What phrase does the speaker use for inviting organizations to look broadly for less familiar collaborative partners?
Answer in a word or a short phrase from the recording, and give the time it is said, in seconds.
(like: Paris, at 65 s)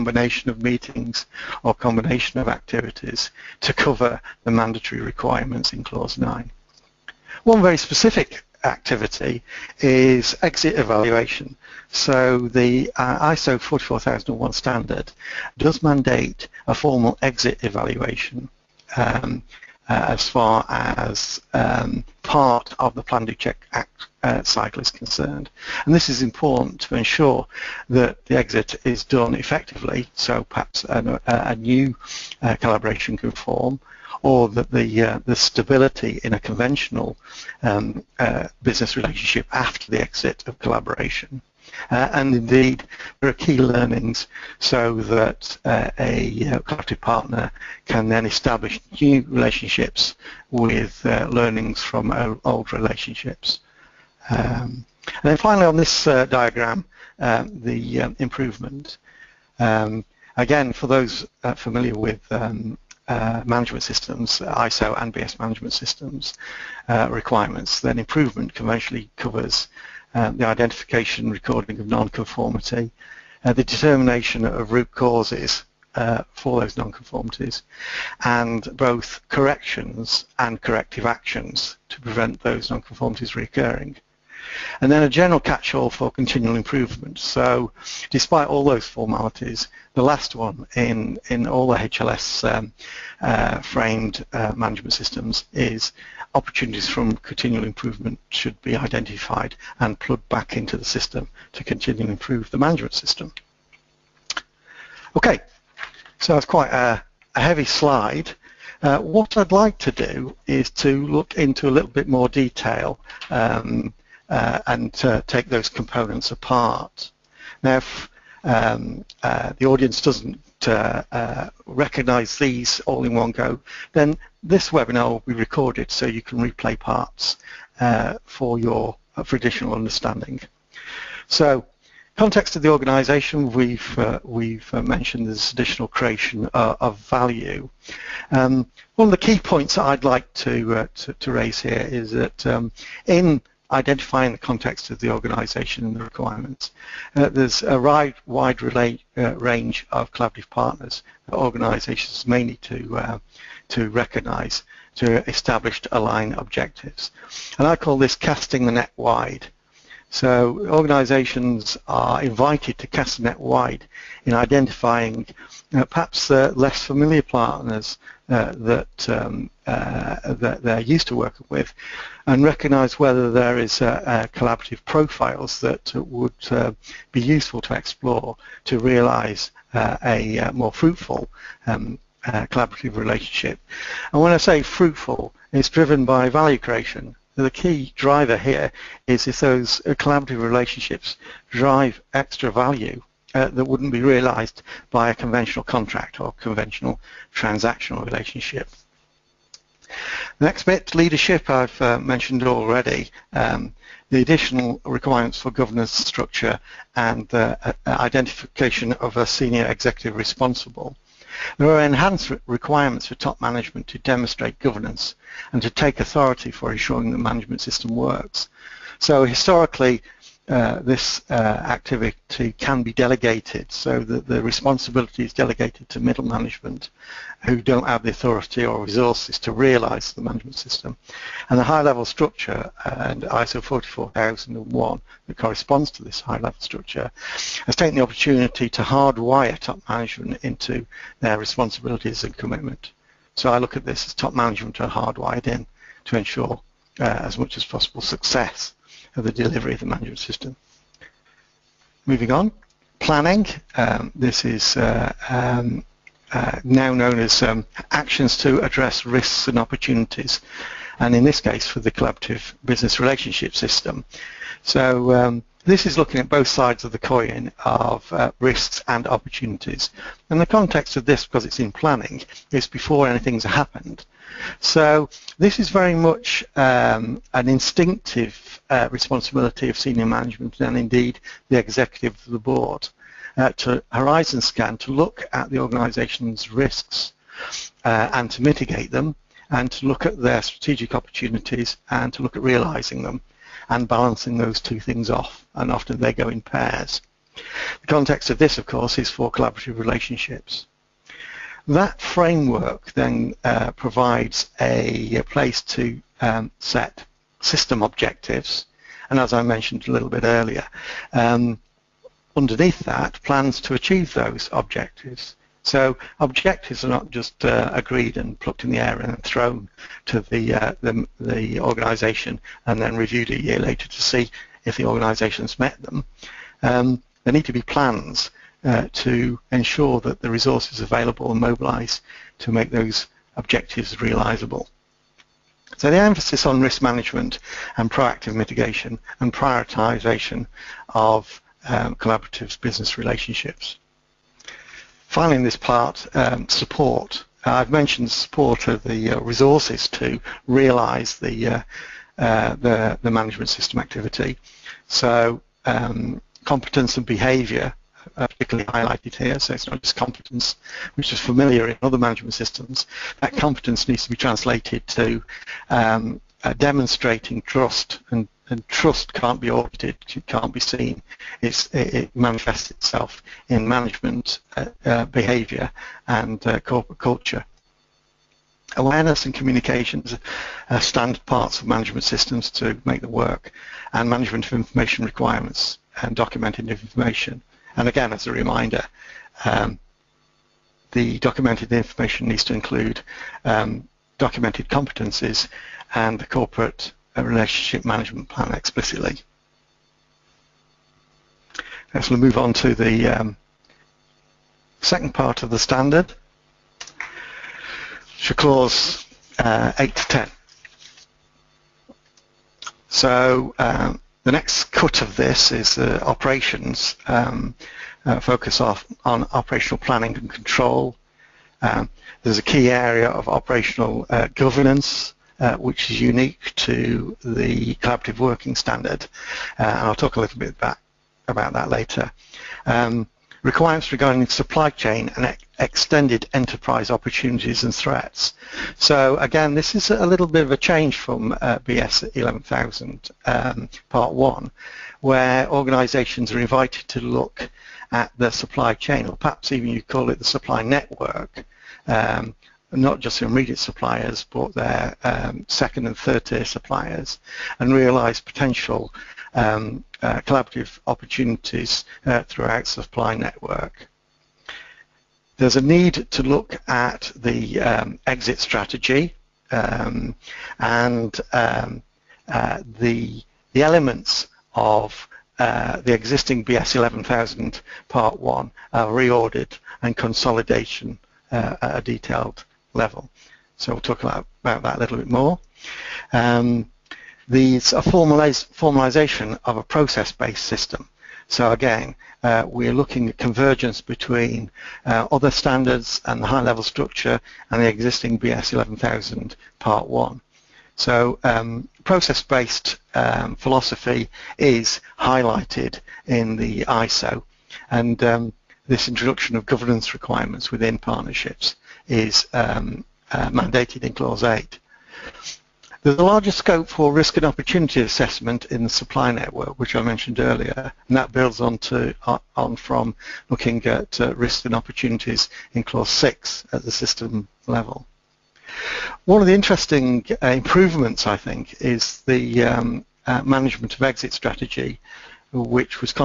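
casting the net wide, at 158 s.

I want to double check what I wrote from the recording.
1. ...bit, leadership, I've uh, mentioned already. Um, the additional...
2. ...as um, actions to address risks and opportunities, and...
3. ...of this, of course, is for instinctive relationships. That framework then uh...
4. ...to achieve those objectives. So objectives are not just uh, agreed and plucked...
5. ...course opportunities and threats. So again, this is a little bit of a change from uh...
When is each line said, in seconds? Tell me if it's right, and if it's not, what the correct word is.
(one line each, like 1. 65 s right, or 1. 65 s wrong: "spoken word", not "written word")
1. 200 s right
2. 257 s right
3. 298 s wrong: "collaborative", not "instinctive"
4. 313 s right
5. 436 s wrong: "enterprise", not "course".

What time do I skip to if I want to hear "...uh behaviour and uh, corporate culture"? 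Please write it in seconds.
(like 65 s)
374 s.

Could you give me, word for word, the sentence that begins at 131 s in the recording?
So context of the organisation, we've uh, we've mentioned this additional creation uh, of value.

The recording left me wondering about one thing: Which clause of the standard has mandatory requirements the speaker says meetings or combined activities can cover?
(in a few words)
Clause 9.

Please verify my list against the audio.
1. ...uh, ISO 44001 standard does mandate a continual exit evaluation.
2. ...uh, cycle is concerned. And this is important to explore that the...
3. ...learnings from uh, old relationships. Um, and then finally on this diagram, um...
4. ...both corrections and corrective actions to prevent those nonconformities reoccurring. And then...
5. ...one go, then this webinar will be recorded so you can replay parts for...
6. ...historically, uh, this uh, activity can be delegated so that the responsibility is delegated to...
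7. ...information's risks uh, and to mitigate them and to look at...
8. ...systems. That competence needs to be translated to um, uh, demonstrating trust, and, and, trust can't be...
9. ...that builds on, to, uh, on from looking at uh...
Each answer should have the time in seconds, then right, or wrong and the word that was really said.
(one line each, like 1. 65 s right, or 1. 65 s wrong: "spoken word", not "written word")
1. 12 s wrong: "formal", not "continual"
2. 24 s wrong: "ensure", not "explore"
3. 51 s right
4. 78 s right
5. 123 s right
6. 219 s right
7. 285 s wrong: "organisation", not "information"
8. 362 s right
9. 520 s right.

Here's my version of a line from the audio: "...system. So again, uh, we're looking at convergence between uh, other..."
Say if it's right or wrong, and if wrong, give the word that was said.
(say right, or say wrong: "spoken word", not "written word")
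right.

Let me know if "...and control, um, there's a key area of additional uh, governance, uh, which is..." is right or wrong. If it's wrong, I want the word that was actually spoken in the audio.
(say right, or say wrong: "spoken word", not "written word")
wrong: "operational", not "additional".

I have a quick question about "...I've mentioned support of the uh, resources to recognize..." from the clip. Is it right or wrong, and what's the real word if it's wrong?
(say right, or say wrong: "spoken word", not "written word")
wrong: "realize", not "recognize".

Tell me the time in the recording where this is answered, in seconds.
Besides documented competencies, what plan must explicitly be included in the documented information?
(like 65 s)
396 s.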